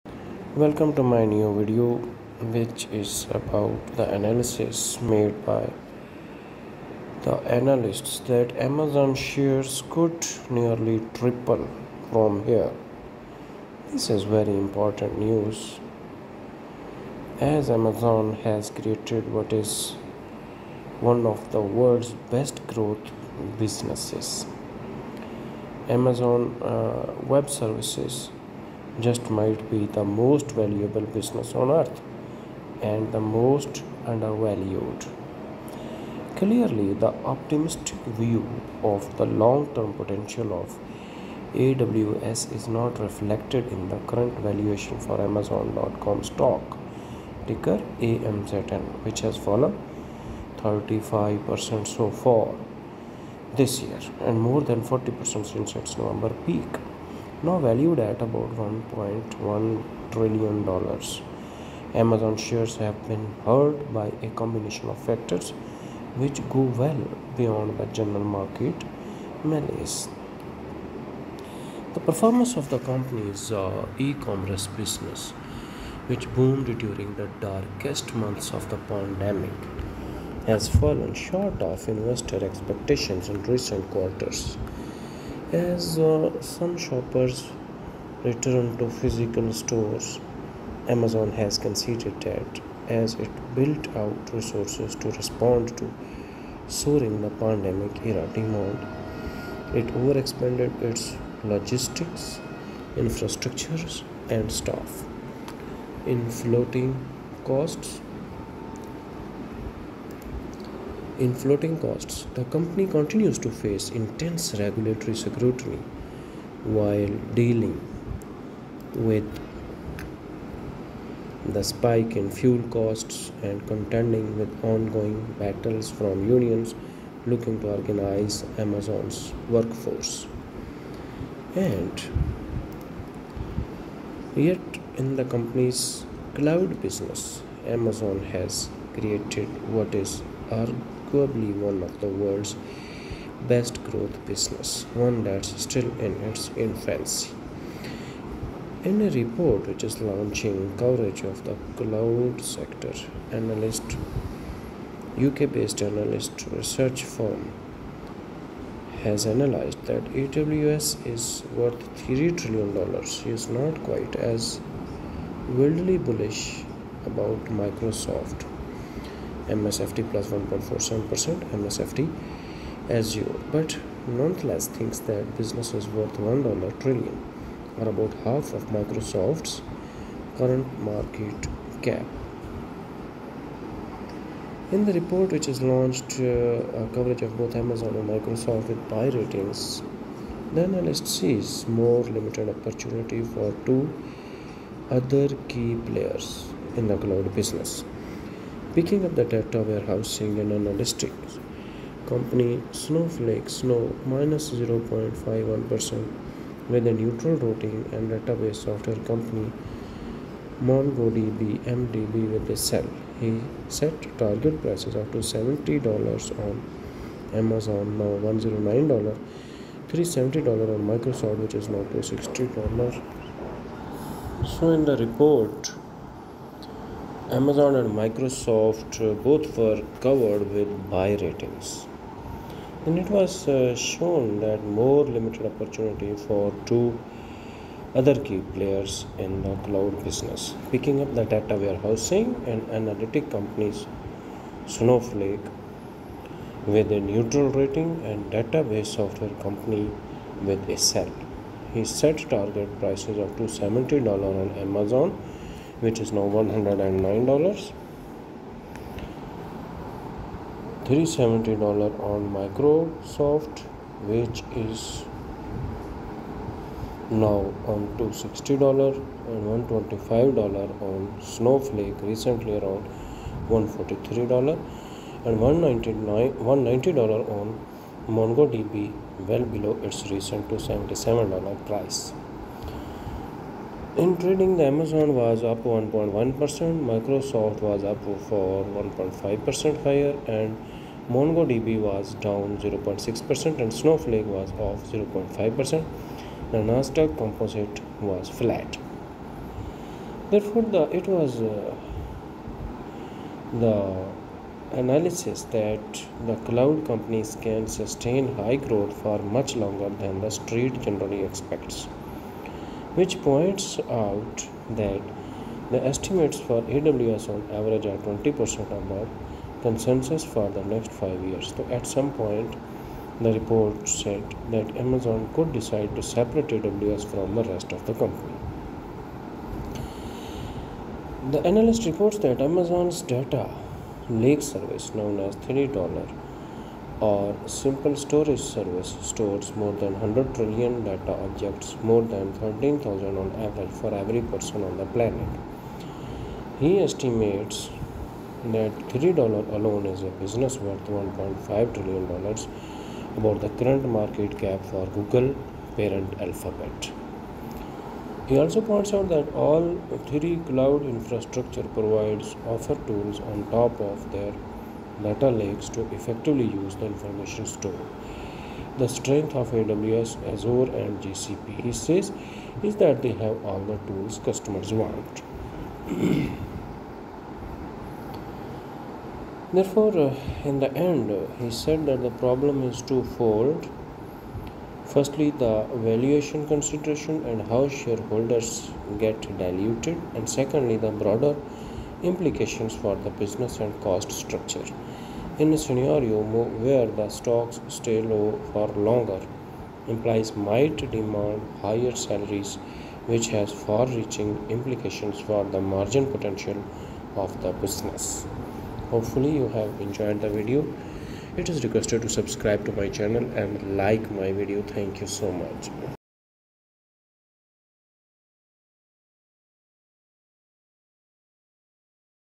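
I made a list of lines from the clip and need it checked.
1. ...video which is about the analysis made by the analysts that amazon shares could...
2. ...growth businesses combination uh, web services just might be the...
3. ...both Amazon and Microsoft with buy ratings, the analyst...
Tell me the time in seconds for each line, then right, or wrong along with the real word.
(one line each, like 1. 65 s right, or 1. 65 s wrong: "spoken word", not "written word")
1. 1 s right
2. 22 s wrong: "amazon", not "combination"
3. 187 s right.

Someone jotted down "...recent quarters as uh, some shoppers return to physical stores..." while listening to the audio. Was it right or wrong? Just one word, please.
right.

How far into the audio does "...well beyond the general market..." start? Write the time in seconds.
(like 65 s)
66 s.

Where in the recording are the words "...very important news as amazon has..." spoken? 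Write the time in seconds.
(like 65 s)
14 s.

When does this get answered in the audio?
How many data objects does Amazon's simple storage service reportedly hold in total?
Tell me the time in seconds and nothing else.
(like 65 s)
339 s.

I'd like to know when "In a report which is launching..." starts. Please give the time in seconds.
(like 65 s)
148 s.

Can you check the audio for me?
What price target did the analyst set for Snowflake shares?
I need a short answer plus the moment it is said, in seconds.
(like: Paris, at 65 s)
$125, at 269 s.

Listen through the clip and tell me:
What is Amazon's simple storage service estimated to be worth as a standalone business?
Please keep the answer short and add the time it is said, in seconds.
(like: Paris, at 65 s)
$1.5 trillion, at 350 s.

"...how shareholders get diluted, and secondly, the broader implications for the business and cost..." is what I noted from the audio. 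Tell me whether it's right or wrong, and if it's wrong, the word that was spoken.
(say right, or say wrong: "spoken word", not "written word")
right.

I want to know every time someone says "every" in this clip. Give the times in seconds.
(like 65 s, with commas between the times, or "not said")
343 s.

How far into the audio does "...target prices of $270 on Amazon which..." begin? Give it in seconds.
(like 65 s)
252 s.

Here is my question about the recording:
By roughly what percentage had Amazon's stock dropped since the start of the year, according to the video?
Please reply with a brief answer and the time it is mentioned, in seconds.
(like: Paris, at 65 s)
35%, at 50 s.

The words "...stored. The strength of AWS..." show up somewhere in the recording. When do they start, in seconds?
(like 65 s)
367 s.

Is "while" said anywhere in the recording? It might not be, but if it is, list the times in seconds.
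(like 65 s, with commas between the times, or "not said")
116 s.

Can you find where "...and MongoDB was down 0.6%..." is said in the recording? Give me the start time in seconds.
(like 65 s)
290 s.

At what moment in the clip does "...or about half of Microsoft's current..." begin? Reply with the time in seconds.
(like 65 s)
177 s.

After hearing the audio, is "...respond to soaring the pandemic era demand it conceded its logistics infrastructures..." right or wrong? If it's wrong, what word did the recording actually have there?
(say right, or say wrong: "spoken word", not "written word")
wrong: "overexpanded", not "conceded".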